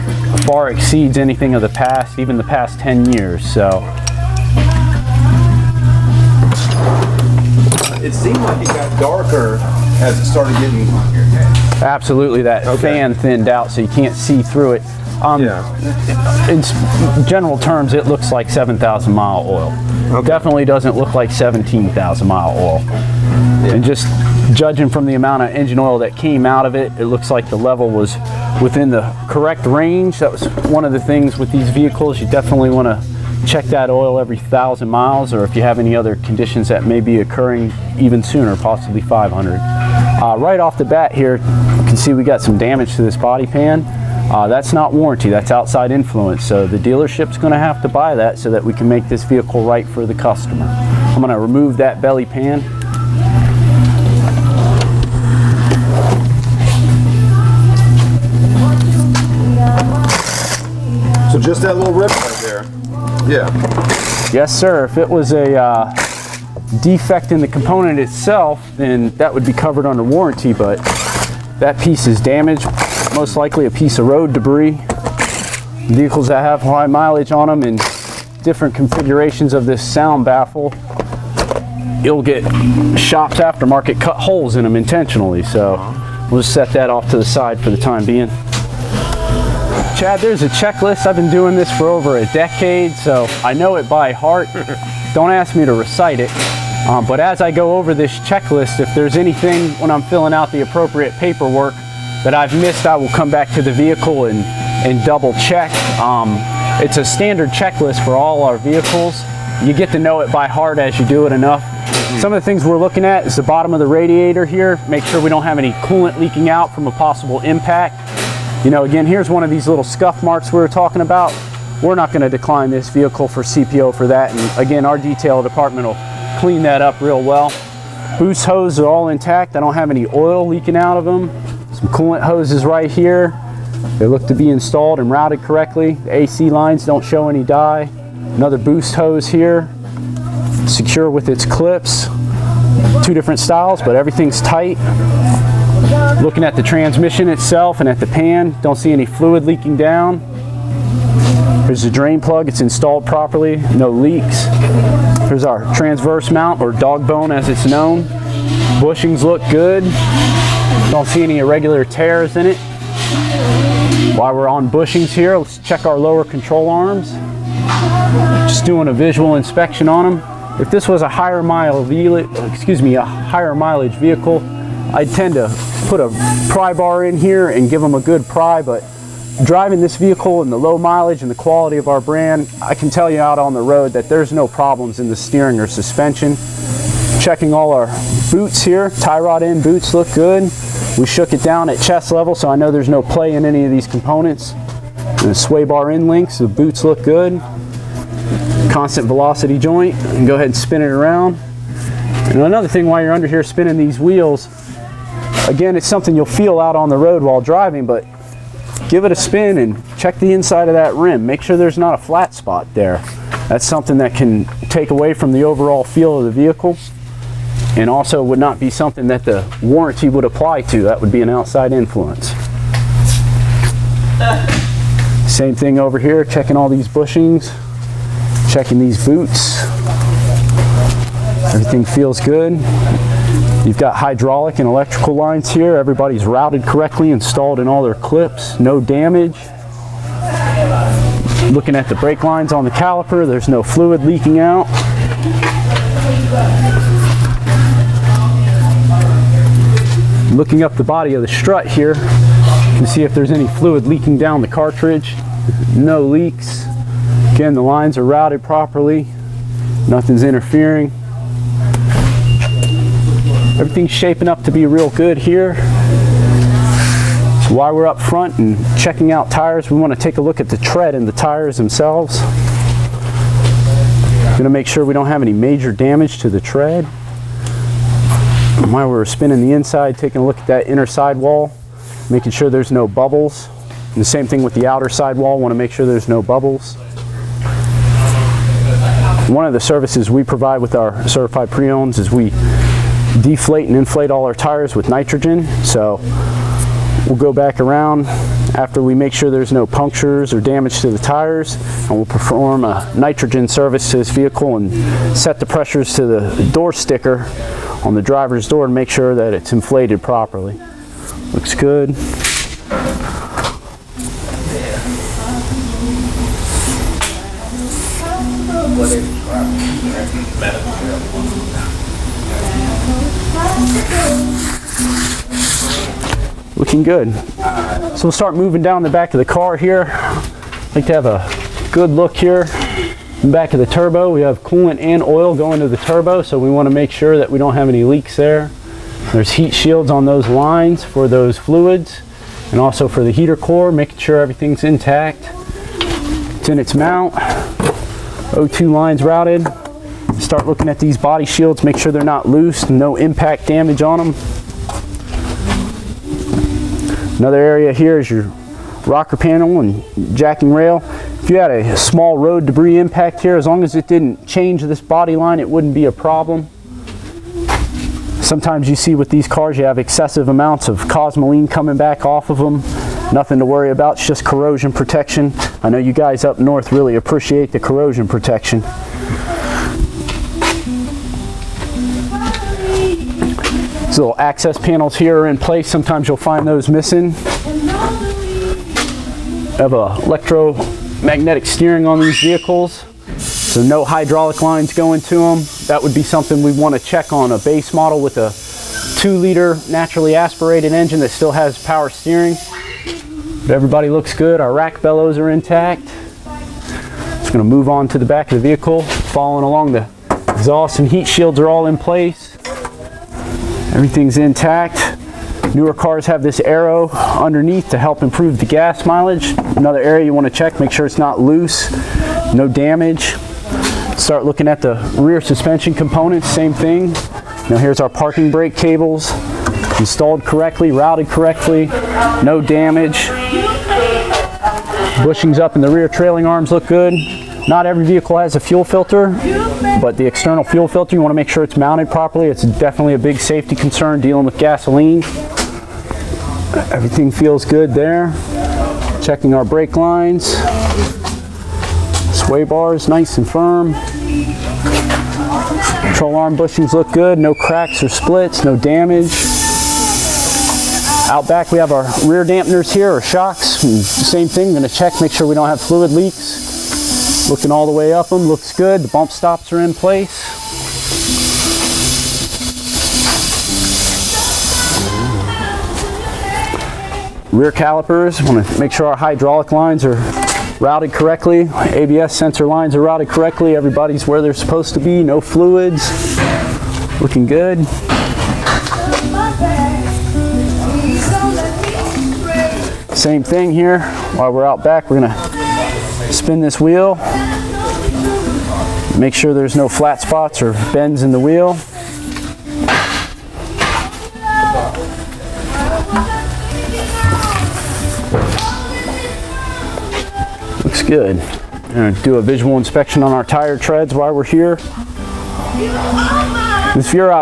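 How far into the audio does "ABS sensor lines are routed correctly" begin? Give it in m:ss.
8:01.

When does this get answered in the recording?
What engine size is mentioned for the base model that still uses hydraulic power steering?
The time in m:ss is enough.
6:38.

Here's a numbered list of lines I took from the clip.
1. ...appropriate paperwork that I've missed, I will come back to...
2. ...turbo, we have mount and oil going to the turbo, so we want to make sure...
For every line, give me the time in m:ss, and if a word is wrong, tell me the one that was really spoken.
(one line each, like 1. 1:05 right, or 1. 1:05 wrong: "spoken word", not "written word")
1. 1:40 right
2. 5:33 wrong: "coolant", not "mount".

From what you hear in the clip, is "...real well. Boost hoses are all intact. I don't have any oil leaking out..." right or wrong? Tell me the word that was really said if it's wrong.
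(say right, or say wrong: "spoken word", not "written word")
right.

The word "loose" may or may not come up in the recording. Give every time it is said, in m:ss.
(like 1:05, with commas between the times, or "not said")
5:52, 7:01.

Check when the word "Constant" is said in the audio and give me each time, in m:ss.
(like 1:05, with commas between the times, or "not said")
3:18.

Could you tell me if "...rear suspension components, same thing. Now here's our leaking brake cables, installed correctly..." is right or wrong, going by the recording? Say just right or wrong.
wrong.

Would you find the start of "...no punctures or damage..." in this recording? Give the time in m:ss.
4:59.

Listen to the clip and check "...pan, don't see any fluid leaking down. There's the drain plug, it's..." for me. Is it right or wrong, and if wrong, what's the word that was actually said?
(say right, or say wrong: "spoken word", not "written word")
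right.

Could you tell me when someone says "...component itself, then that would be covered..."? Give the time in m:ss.
1:07.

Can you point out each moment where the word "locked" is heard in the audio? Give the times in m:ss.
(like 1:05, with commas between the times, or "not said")
not said.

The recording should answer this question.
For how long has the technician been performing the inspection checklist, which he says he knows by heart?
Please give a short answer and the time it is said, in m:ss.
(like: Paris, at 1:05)
Over a decade, at 1:31.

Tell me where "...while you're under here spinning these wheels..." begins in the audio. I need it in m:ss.
3:22.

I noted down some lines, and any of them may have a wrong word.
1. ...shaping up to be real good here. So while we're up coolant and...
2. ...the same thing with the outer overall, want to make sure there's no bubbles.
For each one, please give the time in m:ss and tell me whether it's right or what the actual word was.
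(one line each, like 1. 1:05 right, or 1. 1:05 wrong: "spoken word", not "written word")
1. 4:23 wrong: "front", not "coolant"
2. 4:43 wrong: "sidewall", not "overall".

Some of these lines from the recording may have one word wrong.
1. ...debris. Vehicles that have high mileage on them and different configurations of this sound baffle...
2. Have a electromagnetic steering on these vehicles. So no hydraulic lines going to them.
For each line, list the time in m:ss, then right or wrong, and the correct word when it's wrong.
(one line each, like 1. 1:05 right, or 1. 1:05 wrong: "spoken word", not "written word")
1. 1:14 right
2. 6:29 right.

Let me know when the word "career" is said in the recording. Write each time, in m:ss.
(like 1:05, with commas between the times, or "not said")
not said.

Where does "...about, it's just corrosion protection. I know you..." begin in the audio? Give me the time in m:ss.
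6:13.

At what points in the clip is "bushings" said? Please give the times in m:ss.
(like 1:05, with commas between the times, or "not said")
2:38, 2:44, 3:46, 7:15, 7:36.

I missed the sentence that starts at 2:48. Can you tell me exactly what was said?
Just doing a visual inspection on them.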